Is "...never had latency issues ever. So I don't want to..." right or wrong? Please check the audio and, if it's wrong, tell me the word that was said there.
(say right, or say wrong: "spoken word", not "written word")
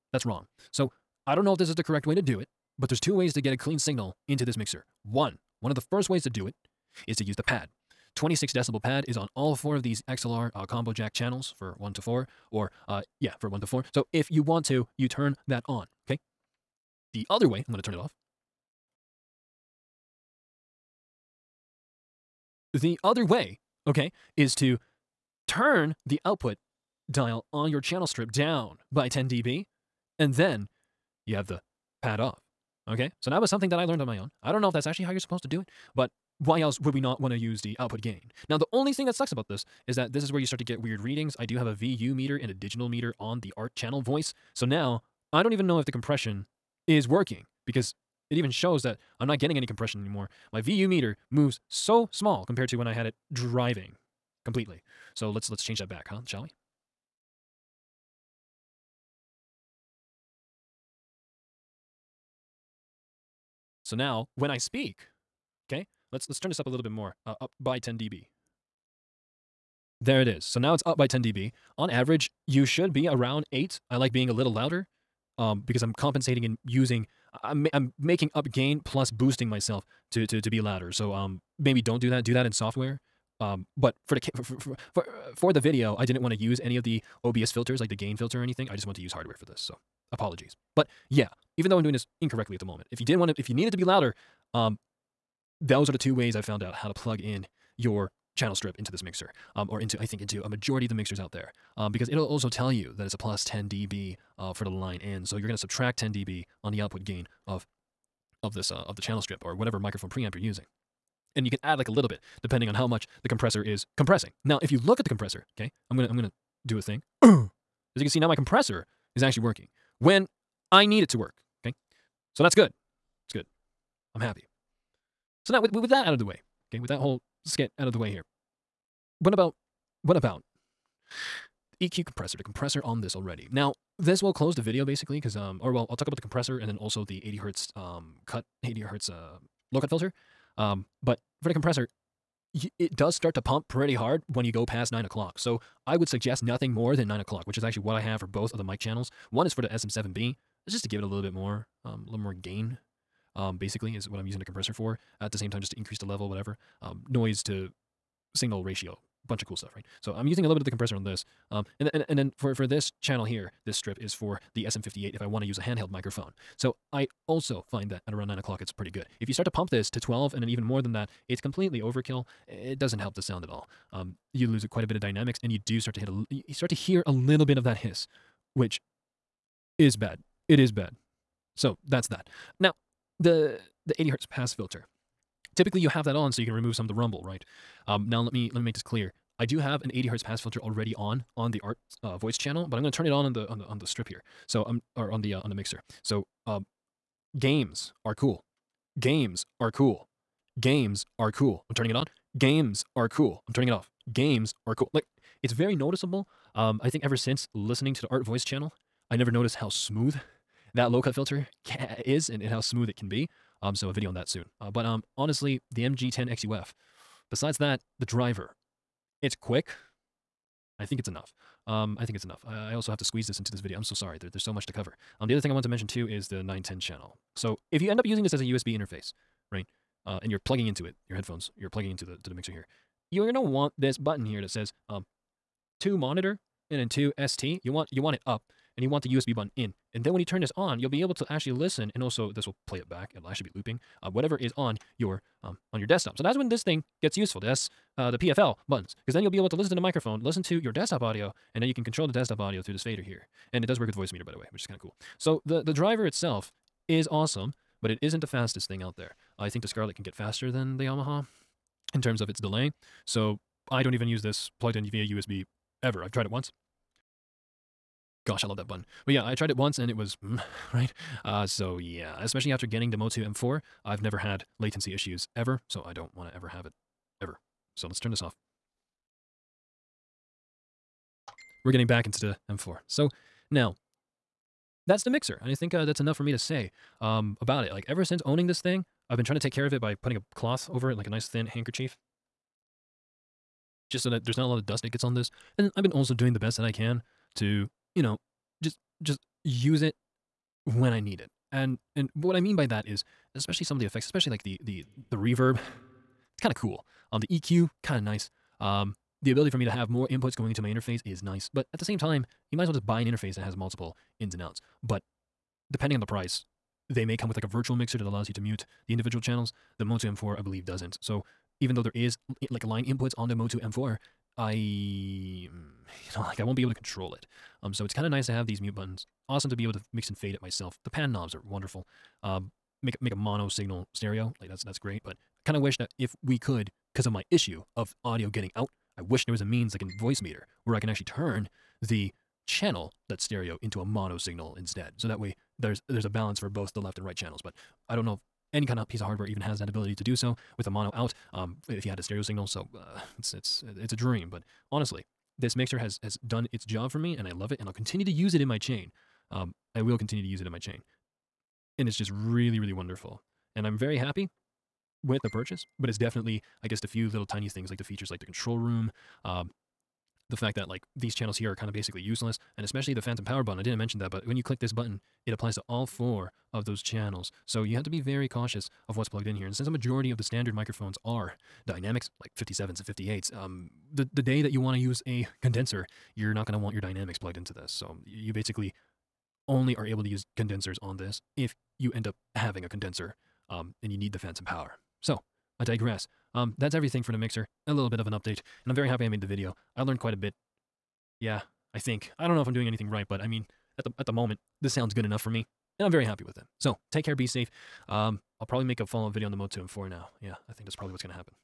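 right.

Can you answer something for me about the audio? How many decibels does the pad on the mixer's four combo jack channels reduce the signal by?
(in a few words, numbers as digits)
26.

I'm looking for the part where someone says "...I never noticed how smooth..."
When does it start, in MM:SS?
03:29.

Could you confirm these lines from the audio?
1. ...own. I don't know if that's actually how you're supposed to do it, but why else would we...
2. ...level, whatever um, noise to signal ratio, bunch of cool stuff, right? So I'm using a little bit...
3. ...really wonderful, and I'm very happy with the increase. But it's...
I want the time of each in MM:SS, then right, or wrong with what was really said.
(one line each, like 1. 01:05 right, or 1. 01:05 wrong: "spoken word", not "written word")
1. 00:34 right
2. 02:36 right
3. 06:02 wrong: "purchase", not "increase".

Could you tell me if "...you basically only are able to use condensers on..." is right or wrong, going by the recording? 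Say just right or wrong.
right.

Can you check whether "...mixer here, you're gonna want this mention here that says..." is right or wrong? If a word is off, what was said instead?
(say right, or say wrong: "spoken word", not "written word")
wrong: "button", not "mention".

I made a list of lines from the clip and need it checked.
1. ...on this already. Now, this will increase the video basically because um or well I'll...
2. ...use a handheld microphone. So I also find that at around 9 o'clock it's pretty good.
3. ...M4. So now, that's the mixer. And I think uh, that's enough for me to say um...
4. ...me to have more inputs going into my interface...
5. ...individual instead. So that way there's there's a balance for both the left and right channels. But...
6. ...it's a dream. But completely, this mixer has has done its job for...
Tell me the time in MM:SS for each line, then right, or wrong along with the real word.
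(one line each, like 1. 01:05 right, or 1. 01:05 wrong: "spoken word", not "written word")
1. 02:12 wrong: "close", not "increase"
2. 02:45 right
3. 04:42 right
4. 05:09 right
5. 05:44 wrong: "signal", not "individual"
6. 05:53 wrong: "honestly", not "completely".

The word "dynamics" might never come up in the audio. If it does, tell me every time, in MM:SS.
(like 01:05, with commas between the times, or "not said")
02:54, 06:21, 06:26.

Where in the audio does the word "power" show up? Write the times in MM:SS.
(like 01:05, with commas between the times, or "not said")
06:13, 06:34.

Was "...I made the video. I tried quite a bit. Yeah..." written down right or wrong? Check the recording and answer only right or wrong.
wrong.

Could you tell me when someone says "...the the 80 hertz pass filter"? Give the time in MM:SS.
03:03.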